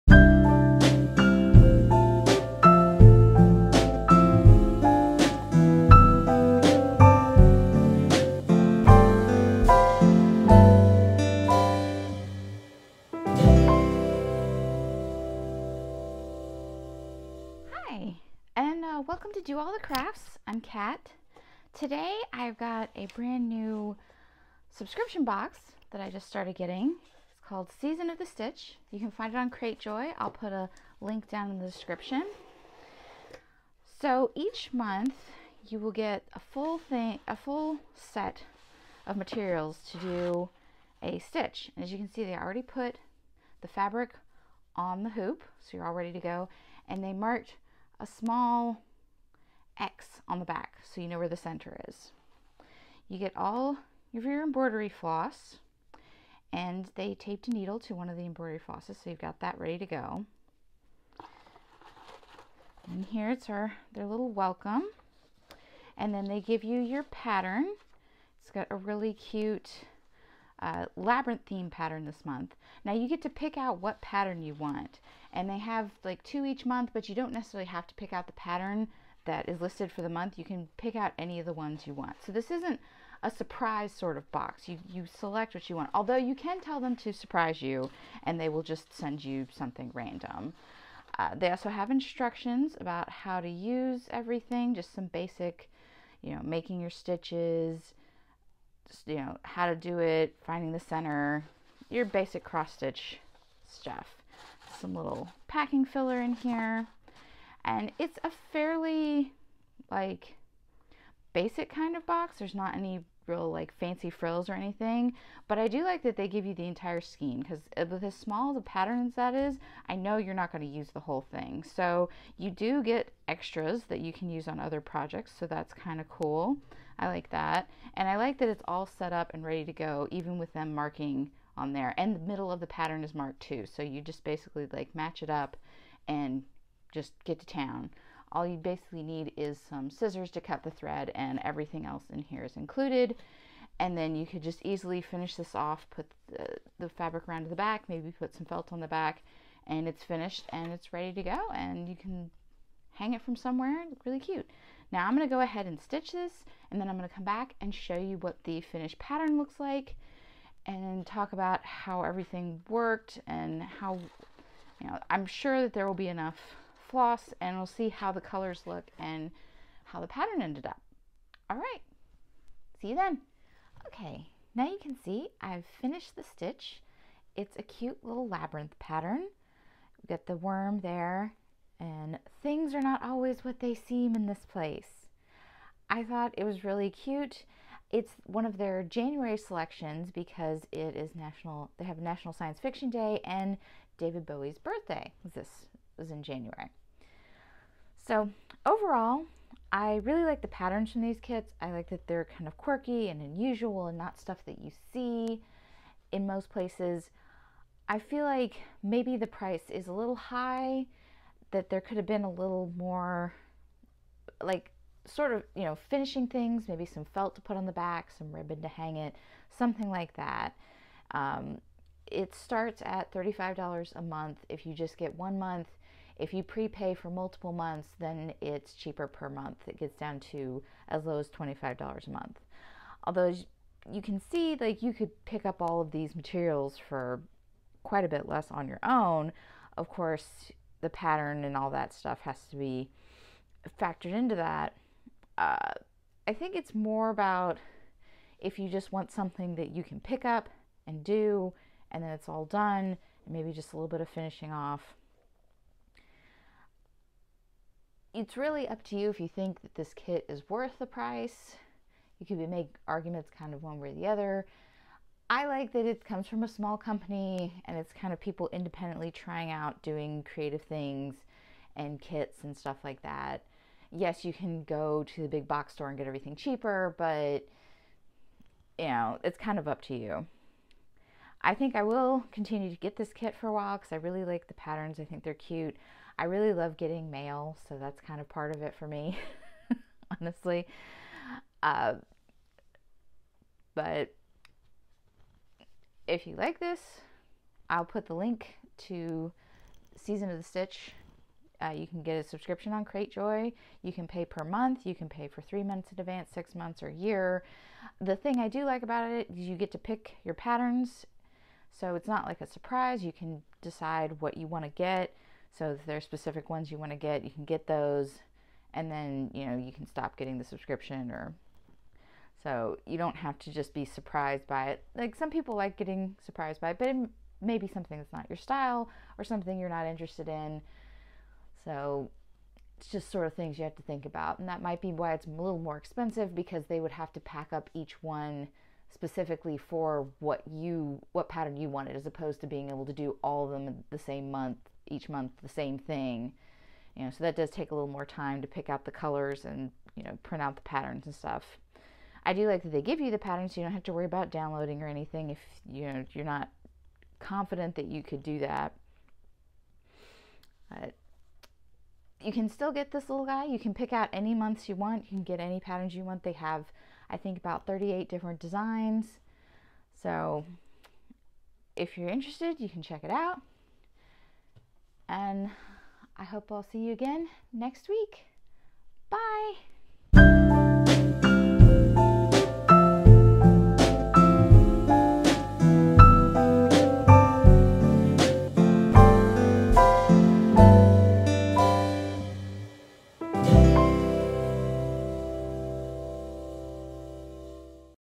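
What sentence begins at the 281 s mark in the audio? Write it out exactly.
I think I will continue to get this kit for a while because I really like the patterns.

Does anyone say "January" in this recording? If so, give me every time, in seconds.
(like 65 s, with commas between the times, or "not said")
188 s, 196 s.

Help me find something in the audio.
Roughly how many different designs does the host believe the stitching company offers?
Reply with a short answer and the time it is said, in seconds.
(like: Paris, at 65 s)
38, at 367 s.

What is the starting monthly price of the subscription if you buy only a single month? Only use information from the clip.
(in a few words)
$35.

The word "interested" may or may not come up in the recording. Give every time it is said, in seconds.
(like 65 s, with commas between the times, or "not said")
329 s, 372 s.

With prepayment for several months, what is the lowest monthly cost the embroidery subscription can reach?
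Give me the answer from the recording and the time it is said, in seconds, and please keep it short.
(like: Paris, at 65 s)
$25, at 231 s.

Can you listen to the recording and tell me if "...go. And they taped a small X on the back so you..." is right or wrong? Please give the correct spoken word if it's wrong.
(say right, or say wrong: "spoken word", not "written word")
wrong: "marked", not "taped".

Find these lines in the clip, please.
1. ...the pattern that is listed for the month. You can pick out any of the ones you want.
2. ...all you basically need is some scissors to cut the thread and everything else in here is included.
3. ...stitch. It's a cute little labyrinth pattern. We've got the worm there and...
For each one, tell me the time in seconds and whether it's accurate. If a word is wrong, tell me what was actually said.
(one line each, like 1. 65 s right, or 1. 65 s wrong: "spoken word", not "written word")
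1. 78 s right
2. 138 s right
3. 176 s right.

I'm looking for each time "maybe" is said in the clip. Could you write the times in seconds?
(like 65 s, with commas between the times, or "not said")
147 s, 208 s, 216 s, 253 s.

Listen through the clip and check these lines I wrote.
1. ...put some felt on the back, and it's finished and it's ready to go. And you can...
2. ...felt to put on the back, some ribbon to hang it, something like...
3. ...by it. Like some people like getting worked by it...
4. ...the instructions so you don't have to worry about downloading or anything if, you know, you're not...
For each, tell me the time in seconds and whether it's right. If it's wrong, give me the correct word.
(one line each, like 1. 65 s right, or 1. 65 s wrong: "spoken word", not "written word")
1. 148 s right
2. 217 s right
3. 324 s wrong: "surprised", not "worked"
4. 353 s wrong: "patterns", not "instructions".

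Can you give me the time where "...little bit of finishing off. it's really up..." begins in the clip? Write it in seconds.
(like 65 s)
253 s.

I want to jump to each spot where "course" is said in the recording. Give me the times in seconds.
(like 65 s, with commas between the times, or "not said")
239 s.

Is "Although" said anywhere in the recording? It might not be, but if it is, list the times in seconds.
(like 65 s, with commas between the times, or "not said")
85 s, 233 s.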